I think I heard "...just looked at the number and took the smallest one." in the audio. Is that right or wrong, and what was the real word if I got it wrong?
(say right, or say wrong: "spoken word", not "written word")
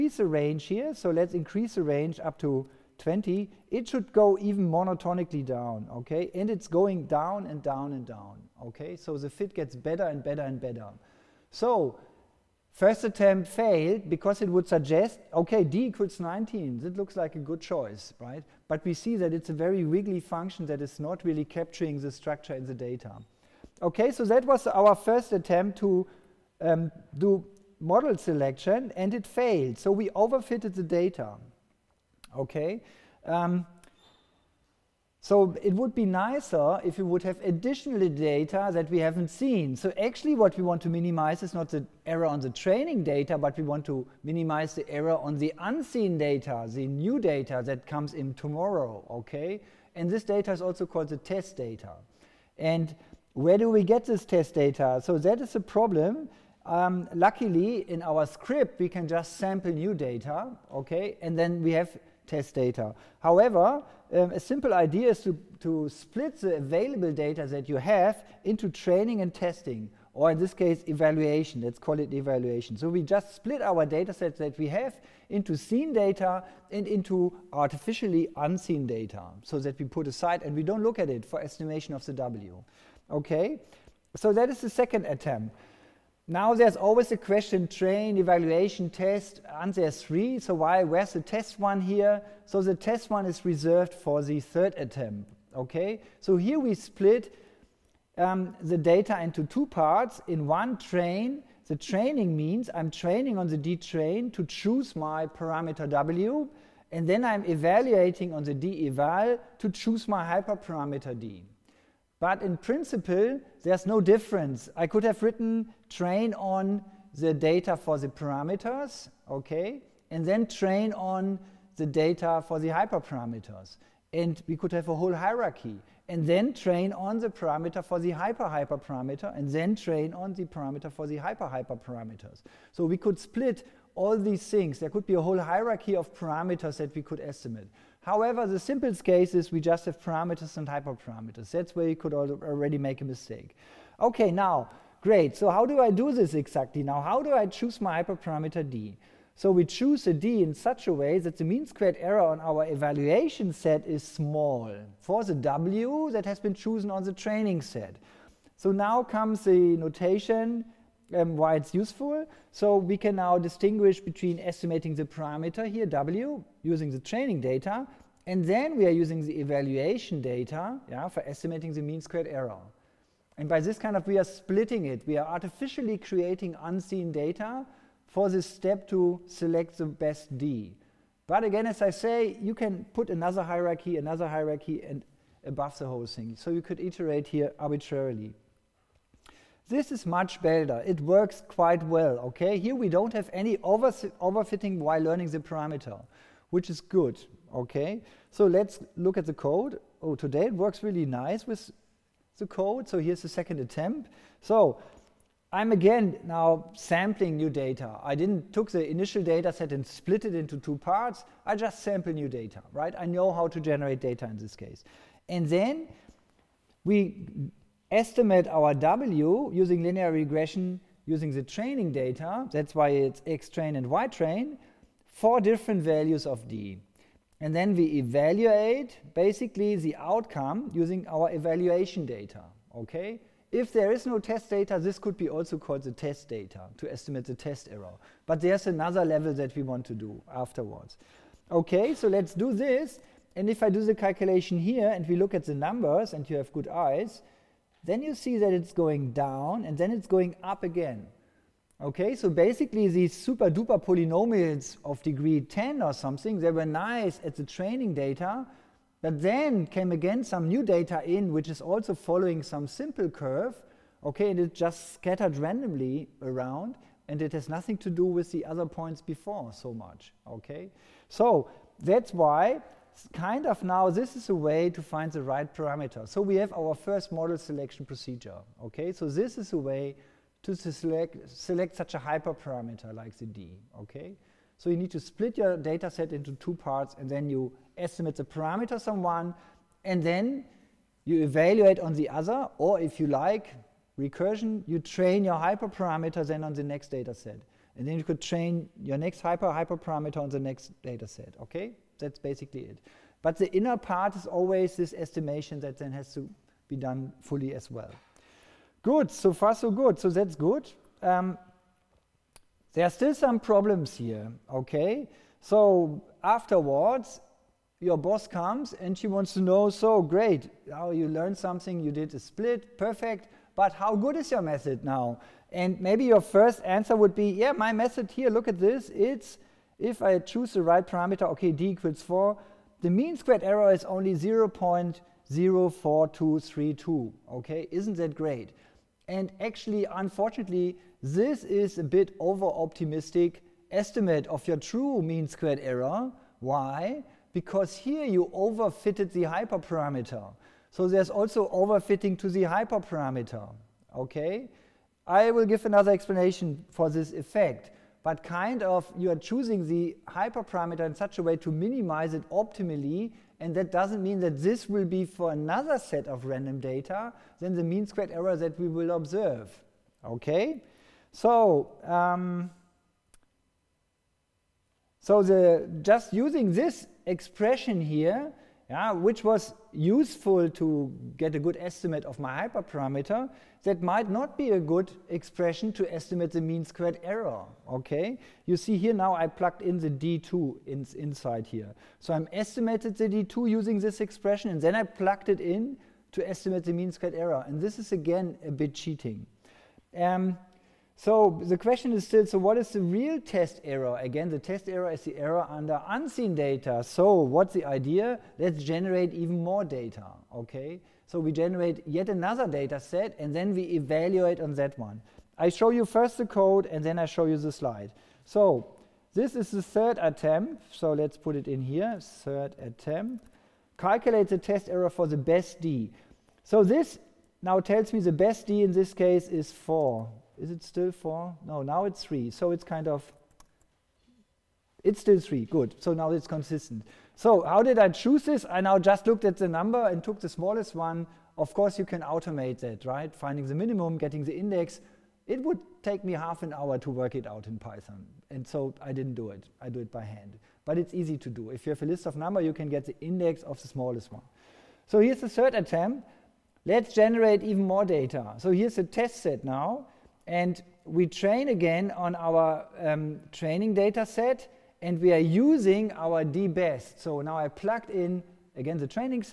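right.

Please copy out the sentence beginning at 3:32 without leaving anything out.
I know how to generate data in this case.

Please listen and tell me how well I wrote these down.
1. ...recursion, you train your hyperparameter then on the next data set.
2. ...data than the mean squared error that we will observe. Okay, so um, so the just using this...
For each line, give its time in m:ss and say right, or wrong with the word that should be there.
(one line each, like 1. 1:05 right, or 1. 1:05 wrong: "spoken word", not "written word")
1. 4:53 right
2. 6:06 right.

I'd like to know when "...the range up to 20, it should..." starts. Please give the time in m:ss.
0:01.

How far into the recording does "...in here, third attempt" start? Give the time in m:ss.
7:01.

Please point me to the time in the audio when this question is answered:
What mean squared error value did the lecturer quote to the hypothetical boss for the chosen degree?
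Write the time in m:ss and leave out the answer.
5:34.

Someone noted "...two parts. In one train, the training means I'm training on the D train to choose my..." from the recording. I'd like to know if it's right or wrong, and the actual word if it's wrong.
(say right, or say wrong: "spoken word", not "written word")
right.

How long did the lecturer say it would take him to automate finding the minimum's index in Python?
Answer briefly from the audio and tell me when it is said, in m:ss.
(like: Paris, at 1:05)
half an hour, at 7:26.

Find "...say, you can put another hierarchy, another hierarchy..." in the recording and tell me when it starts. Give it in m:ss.
3:01.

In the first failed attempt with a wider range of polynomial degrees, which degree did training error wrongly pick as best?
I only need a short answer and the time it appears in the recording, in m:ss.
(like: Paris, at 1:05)
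19, at 0:15.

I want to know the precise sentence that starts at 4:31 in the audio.
So that's why kind of now this is a way to find the right parameter.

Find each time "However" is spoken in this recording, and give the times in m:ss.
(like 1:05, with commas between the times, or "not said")
1:03, 2:18.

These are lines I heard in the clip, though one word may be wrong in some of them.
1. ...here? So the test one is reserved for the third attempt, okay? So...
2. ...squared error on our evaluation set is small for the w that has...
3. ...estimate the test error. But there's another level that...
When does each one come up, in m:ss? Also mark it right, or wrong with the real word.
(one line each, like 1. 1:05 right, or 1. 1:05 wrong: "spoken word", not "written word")
1. 1:31 right
2. 2:31 right
3. 3:56 right.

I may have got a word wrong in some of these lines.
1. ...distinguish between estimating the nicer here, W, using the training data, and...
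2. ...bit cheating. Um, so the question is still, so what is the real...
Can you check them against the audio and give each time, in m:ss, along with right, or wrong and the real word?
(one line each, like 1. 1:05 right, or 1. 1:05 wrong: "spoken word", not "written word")
1. 2:43 wrong: "parameter", not "nicer"
2. 6:38 right.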